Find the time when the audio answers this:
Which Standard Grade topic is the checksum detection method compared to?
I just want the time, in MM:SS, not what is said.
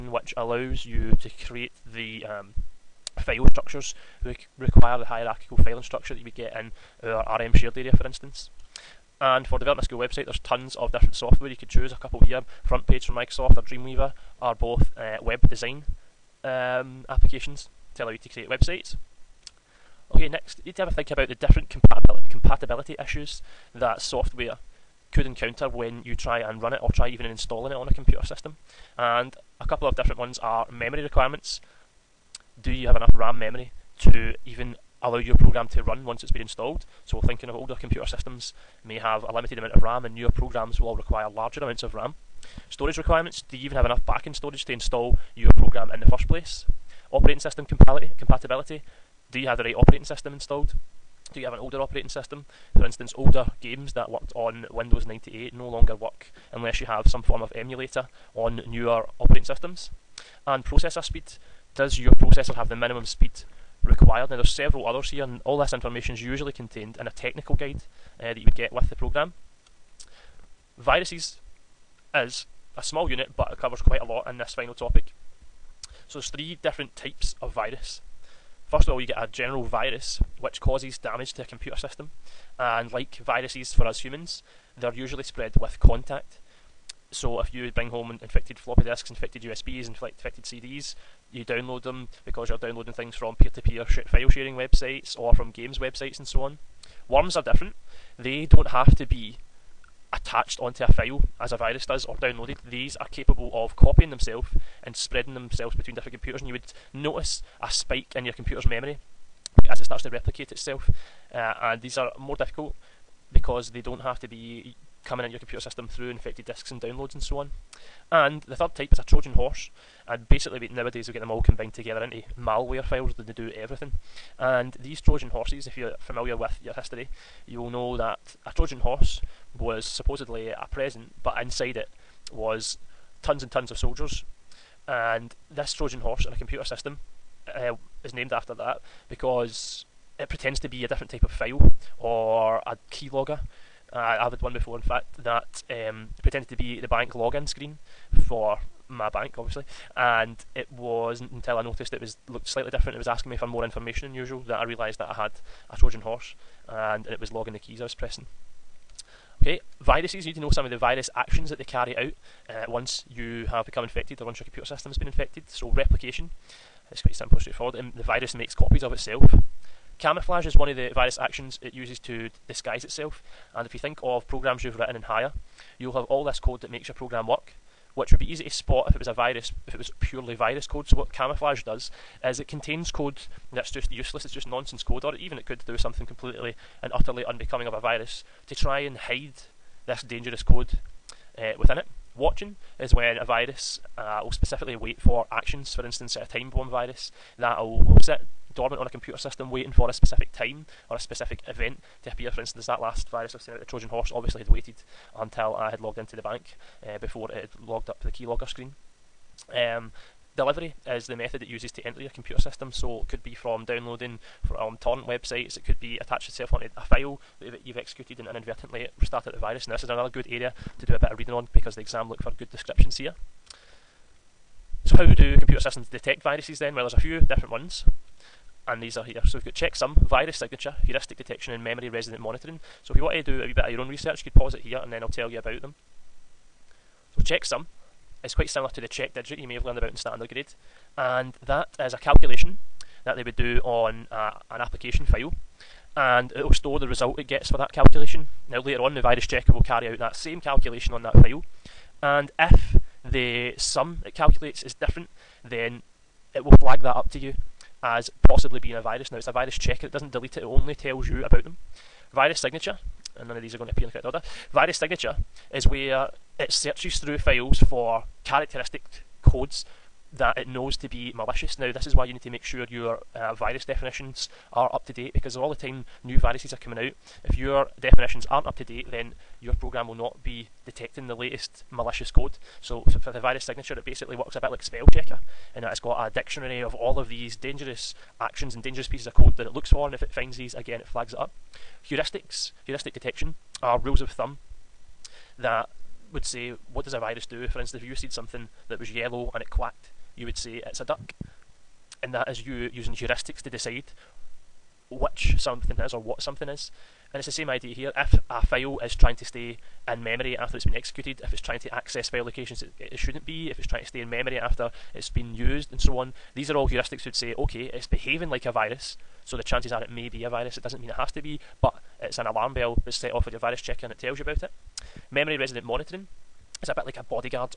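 03:58.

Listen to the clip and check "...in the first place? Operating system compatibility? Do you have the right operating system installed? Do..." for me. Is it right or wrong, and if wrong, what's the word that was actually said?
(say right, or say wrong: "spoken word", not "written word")
right.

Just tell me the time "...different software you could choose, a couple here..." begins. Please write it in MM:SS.
00:10.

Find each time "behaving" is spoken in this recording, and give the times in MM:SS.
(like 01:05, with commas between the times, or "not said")
05:17.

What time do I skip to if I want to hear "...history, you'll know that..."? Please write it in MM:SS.
02:06.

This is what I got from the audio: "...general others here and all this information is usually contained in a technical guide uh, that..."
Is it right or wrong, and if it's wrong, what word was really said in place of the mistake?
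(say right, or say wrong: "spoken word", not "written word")
wrong: "several", not "general".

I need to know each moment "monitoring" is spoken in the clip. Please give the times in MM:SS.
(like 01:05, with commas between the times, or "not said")
03:52, 05:25.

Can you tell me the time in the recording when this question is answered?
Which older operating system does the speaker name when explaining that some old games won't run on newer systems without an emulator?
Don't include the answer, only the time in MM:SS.
00:54.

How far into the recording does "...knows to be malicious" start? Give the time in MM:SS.
04:30.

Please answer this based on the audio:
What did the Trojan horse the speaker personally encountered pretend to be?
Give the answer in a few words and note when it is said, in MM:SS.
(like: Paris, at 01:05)
bank login screen, at 02:26.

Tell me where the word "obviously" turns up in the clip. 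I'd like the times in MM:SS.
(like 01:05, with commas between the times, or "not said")
02:29, 03:24.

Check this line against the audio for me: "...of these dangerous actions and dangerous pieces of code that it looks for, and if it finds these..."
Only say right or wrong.
right.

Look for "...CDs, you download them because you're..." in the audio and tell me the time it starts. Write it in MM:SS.
01:30.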